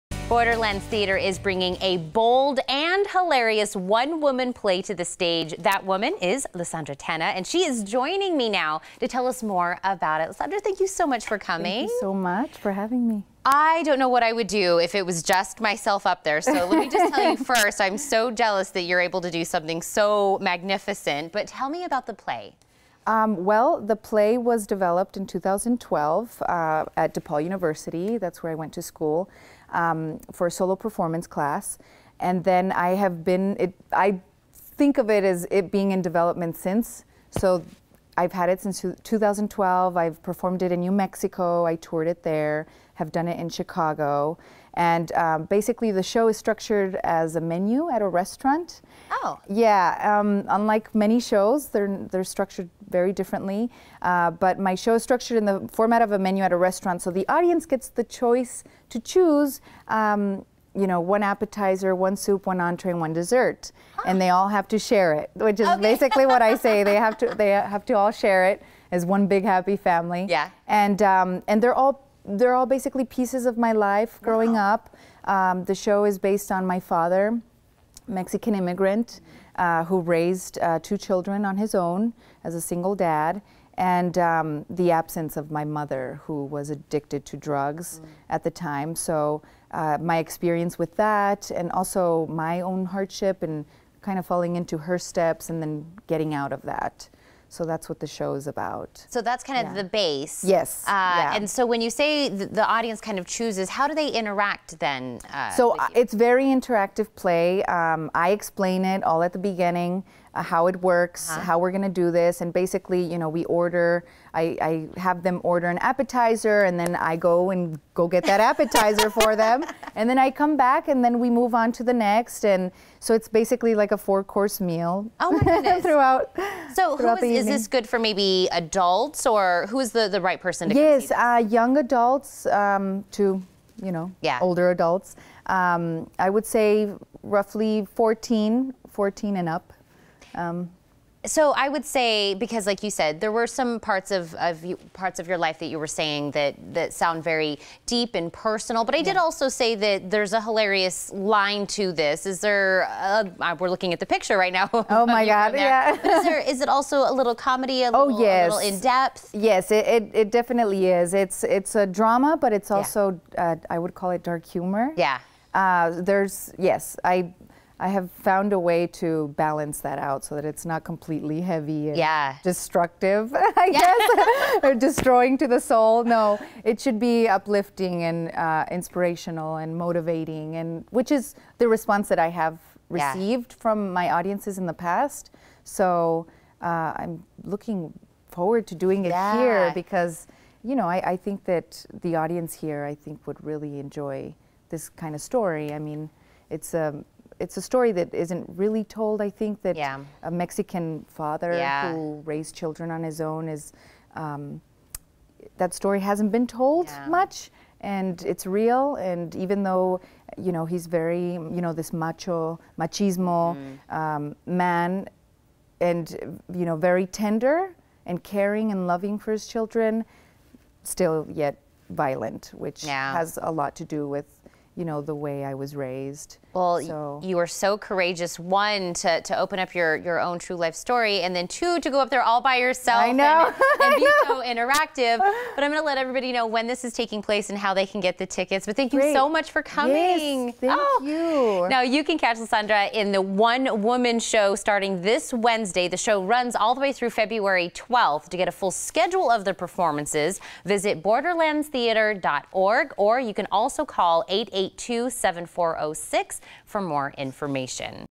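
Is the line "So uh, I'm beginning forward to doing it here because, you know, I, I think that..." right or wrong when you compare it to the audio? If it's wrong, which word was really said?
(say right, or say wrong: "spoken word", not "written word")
wrong: "looking", not "beginning".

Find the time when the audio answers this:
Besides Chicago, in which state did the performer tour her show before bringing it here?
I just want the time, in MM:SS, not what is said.
00:40.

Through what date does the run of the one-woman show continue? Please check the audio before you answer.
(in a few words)
February 12th.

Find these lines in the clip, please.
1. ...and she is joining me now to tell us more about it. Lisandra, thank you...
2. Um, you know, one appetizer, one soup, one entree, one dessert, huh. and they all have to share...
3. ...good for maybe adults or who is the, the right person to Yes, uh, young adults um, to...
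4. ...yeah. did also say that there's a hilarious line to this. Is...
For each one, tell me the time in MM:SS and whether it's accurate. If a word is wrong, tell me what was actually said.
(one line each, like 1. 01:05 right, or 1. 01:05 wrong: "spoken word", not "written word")
1. 00:07 right
2. 00:59 right
3. 02:07 right
4. 02:28 right.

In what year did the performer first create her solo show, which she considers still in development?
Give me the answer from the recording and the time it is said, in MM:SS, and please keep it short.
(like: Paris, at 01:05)
2012, at 00:25.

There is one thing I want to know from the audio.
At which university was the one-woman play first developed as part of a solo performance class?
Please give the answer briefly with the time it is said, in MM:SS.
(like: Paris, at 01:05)
DePaul University, at 00:27.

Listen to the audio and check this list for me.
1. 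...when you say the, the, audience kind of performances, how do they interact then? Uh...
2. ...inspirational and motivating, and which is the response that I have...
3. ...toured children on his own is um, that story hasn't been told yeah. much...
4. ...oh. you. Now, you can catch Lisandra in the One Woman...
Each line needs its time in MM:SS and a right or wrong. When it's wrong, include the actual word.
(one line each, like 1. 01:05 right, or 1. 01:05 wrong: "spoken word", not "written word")
1. 01:41 wrong: "chooses", not "performances"
2. 02:58 right
3. 03:22 wrong: "raised", not "toured"
4. 04:00 right.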